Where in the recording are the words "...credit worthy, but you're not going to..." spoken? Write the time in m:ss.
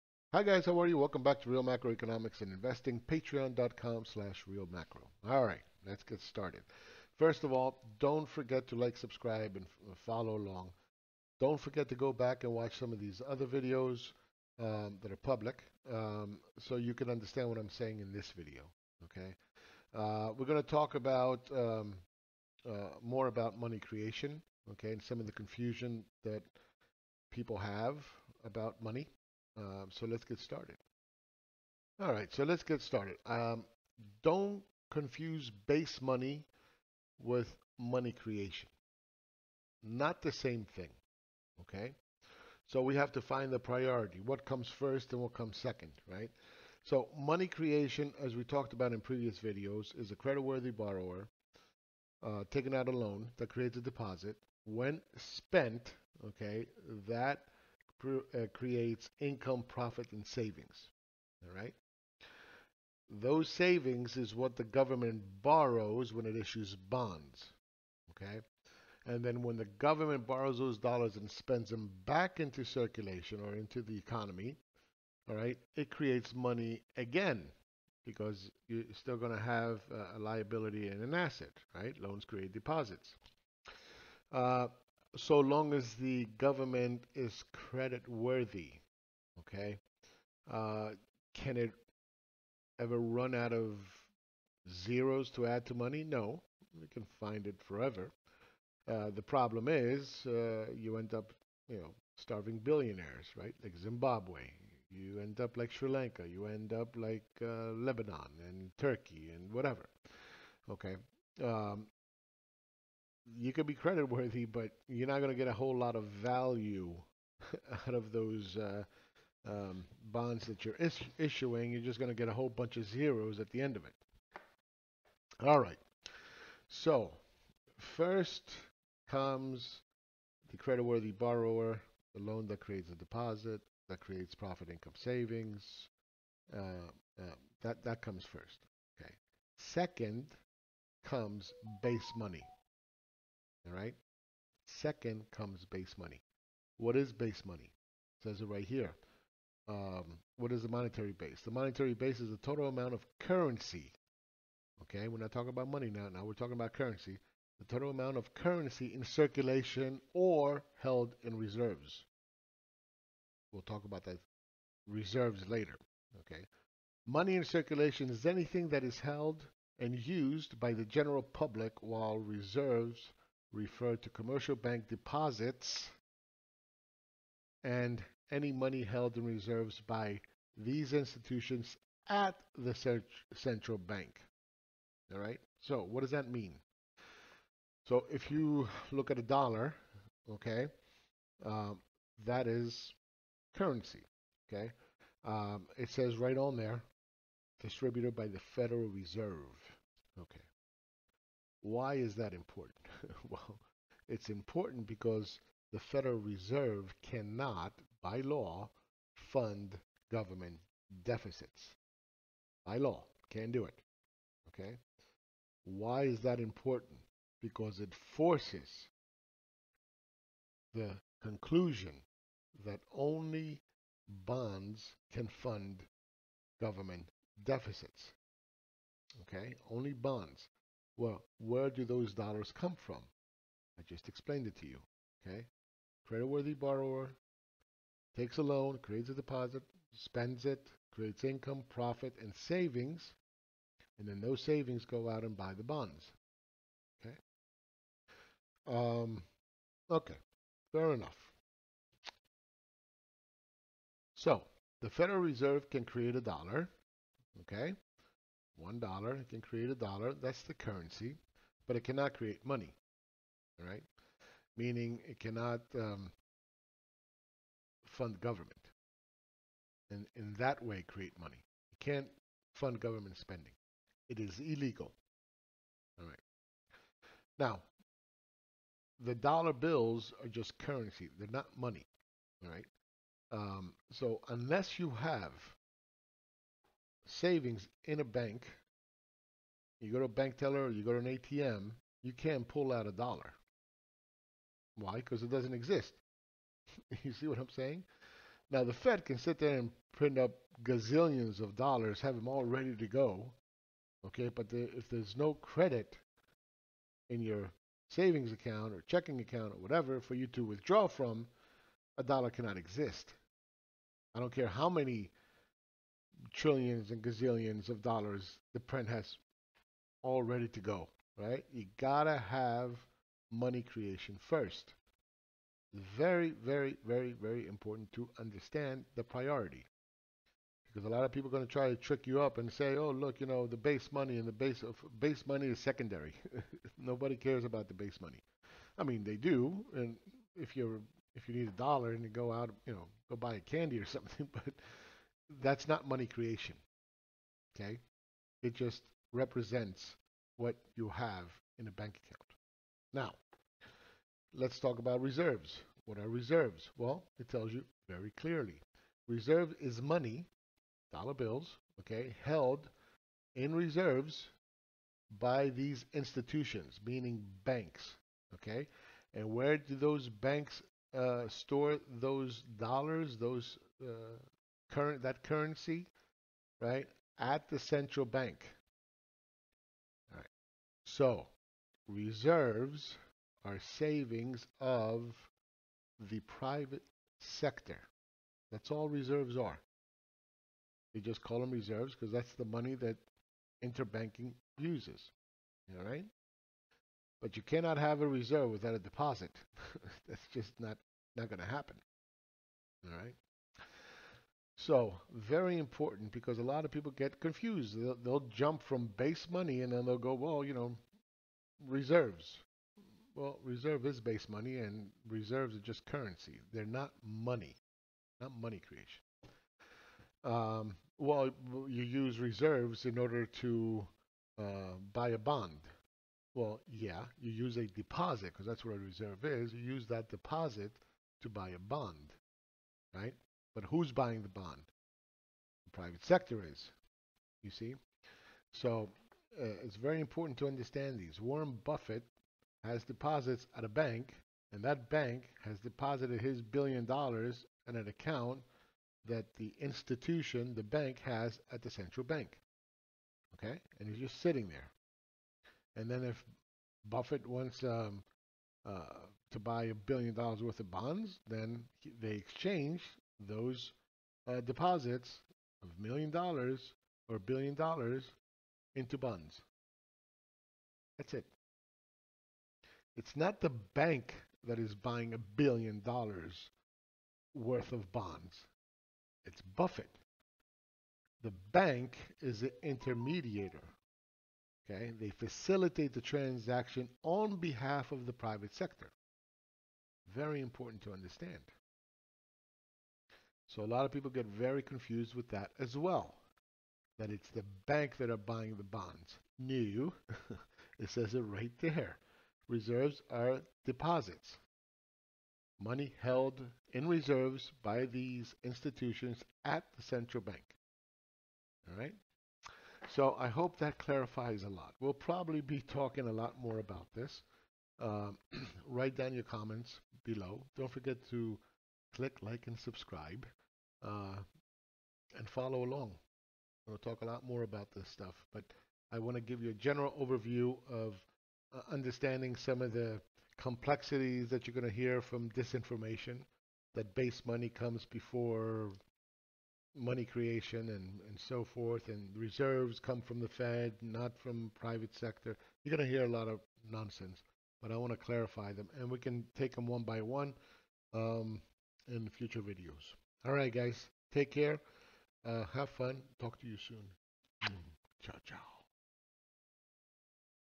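1:53.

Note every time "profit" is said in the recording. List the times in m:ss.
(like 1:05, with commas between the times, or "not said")
0:59, 2:14, 4:01.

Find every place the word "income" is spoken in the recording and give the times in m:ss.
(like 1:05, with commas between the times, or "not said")
0:59, 2:14, 4:01.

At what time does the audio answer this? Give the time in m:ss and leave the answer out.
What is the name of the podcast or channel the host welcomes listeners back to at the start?
0:01.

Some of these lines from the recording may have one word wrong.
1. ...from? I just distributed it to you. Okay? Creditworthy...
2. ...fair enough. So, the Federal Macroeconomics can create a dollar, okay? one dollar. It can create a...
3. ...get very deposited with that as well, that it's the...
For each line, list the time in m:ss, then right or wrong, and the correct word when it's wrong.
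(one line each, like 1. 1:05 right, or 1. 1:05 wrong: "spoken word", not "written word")
1. 3:52 wrong: "explained", not "distributed"
2. 4:10 wrong: "Reserve", not "Macroeconomics"
3. 8:14 wrong: "confused", not "deposited".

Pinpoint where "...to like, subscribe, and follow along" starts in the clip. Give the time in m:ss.
0:08.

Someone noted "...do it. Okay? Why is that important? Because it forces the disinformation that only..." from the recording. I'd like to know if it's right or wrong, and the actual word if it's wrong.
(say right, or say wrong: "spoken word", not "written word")
wrong: "conclusion", not "disinformation".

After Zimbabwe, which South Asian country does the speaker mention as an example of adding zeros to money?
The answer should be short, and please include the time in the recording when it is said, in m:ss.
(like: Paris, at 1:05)
Sri Lanka, at 1:45.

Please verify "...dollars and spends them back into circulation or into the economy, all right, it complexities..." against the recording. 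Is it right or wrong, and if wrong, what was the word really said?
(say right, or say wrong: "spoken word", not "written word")
wrong: "creates", not "complexities".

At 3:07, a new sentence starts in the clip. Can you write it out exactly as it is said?
So if you look at a dollar, okay, um, that is currency.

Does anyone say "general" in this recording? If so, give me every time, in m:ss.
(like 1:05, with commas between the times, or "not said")
2:50, 8:49.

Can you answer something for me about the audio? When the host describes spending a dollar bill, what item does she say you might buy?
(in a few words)
Candy.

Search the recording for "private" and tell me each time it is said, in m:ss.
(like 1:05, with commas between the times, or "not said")
6:26, 7:15, 8:08, 9:04.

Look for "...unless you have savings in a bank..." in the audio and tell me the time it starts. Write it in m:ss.
4:44.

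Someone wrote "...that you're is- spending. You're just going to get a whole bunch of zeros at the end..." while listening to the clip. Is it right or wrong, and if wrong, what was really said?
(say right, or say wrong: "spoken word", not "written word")
wrong: "issuing", not "spending".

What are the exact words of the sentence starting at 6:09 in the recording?
And where do those banks uh, store those dollars, those uh, current that currency, right, at the central bank.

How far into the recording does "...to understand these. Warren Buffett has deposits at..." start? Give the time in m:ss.
7:20.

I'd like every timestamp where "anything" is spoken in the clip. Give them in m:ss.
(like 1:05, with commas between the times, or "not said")
2:48.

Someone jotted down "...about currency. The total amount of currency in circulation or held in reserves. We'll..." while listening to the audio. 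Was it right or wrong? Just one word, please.
right.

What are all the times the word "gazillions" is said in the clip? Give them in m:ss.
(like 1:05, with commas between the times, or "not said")
5:00, 5:17.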